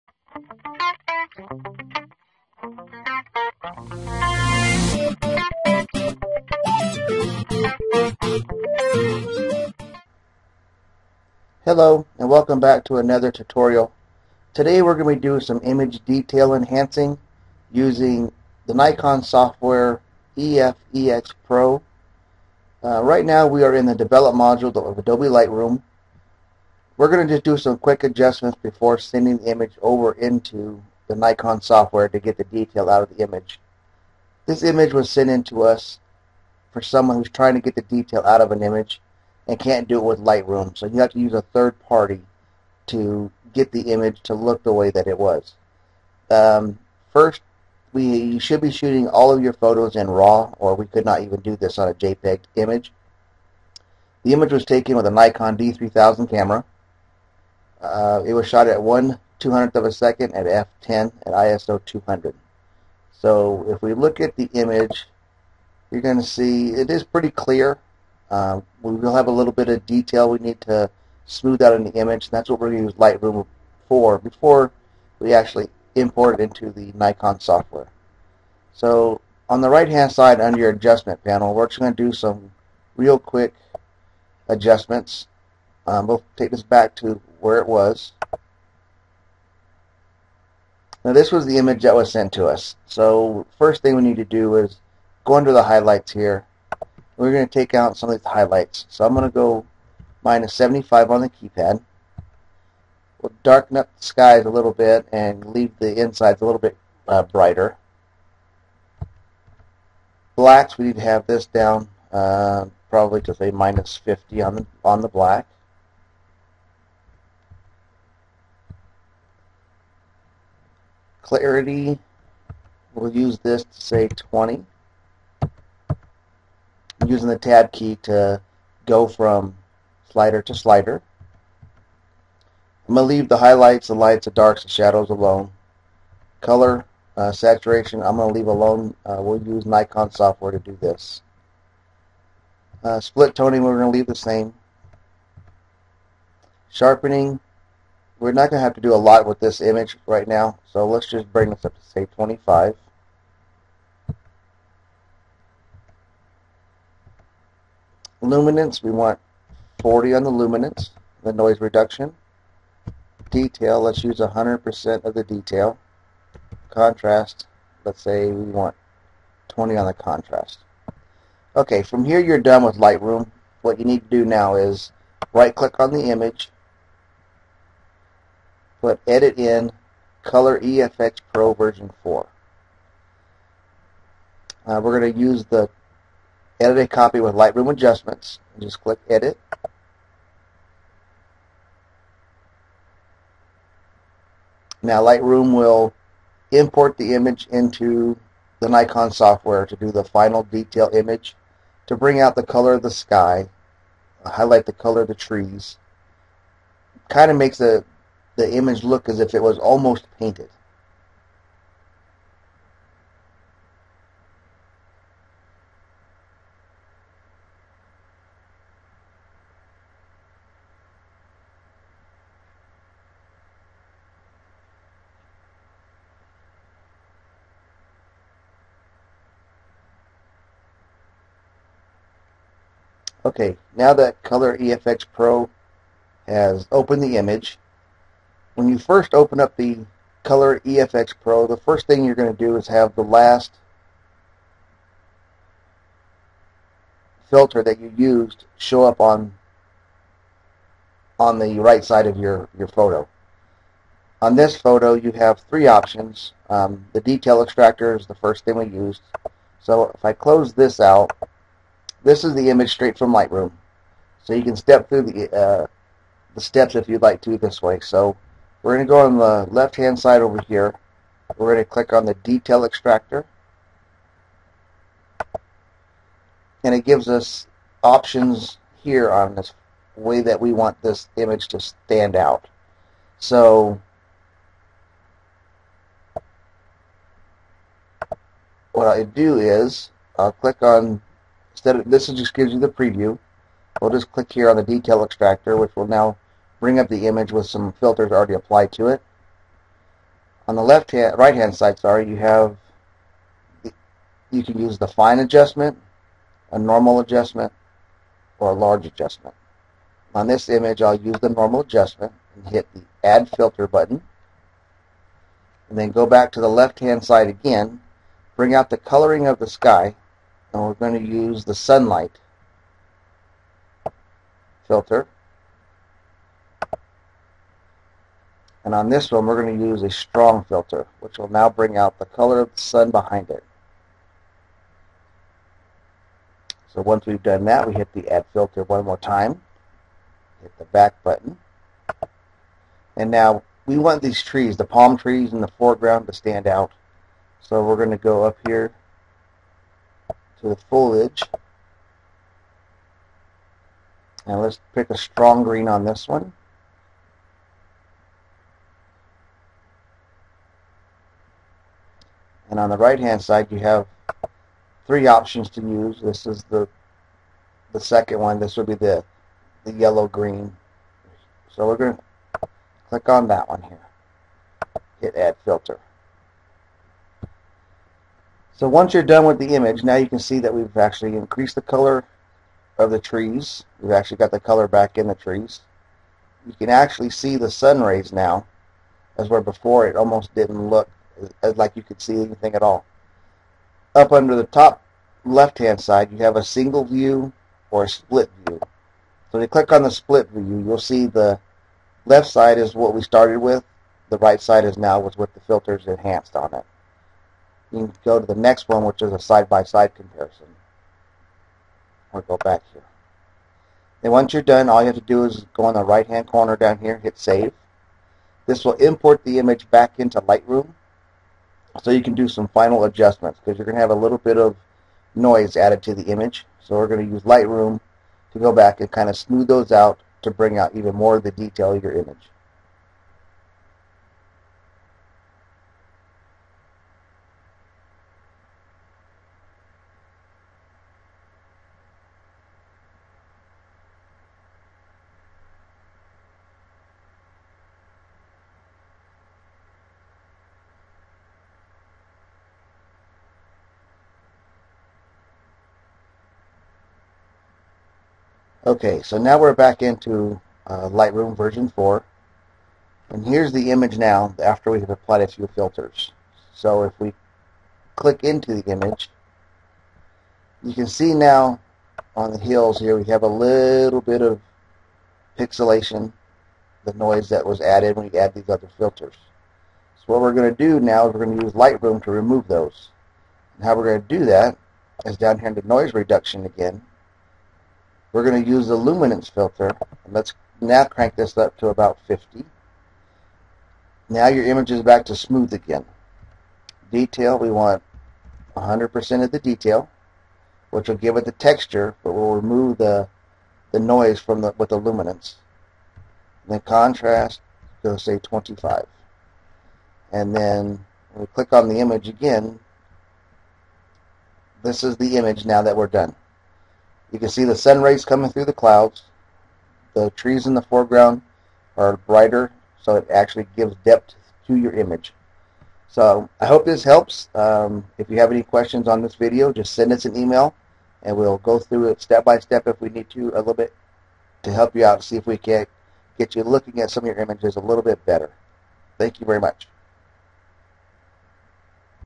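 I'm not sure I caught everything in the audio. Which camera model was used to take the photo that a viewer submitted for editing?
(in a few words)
Nikon D3000.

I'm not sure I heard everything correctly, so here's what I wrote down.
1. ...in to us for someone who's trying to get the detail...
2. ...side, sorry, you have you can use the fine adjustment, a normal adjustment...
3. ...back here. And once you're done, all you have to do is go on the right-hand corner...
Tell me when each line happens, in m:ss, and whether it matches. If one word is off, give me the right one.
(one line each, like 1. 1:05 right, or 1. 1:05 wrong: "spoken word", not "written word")
1. 0:35 right
2. 5:01 right
3. 6:52 right.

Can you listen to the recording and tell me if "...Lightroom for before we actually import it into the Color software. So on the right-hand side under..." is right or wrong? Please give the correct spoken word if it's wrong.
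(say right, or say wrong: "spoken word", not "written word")
wrong: "Nikon", not "Color".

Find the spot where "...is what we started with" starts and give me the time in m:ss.
6:42.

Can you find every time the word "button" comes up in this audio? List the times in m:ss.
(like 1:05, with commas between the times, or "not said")
5:13, 5:41.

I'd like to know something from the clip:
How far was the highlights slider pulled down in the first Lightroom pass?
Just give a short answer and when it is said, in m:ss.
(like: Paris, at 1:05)
-75, at 1:40.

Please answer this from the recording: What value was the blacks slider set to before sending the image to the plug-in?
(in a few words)
-50.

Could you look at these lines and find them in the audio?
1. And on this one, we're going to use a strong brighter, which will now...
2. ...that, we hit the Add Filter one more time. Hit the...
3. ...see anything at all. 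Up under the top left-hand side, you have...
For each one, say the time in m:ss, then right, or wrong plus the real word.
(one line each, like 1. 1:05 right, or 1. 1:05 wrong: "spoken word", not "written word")
1. 5:28 wrong: "filter", not "brighter"
2. 5:37 right
3. 6:32 right.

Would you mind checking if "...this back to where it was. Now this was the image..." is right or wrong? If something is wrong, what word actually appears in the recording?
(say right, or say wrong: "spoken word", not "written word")
right.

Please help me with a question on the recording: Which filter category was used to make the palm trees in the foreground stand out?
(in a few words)
Foliage.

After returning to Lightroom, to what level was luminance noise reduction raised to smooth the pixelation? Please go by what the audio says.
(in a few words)
50.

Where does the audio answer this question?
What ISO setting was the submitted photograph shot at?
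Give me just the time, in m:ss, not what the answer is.
1:01.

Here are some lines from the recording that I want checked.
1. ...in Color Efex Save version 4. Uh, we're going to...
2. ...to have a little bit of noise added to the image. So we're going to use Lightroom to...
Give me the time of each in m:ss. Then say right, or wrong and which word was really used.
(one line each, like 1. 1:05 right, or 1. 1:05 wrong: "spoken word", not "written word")
1. 2:59 wrong: "Pro", not "Save"
2. 7:03 right.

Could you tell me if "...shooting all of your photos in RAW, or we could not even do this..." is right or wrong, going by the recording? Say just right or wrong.
right.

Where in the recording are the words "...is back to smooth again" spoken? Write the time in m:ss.
8:14.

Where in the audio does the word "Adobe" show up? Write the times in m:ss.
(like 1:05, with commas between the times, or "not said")
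0:24.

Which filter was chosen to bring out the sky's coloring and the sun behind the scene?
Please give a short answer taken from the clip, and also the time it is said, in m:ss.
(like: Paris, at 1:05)
Sunlight, at 5:21.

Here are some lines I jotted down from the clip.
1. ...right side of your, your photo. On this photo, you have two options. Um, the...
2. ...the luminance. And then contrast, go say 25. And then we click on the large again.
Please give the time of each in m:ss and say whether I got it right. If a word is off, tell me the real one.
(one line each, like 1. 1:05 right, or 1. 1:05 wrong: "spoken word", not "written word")
1. 4:11 wrong: "three", not "two"
2. 8:24 wrong: "image", not "large".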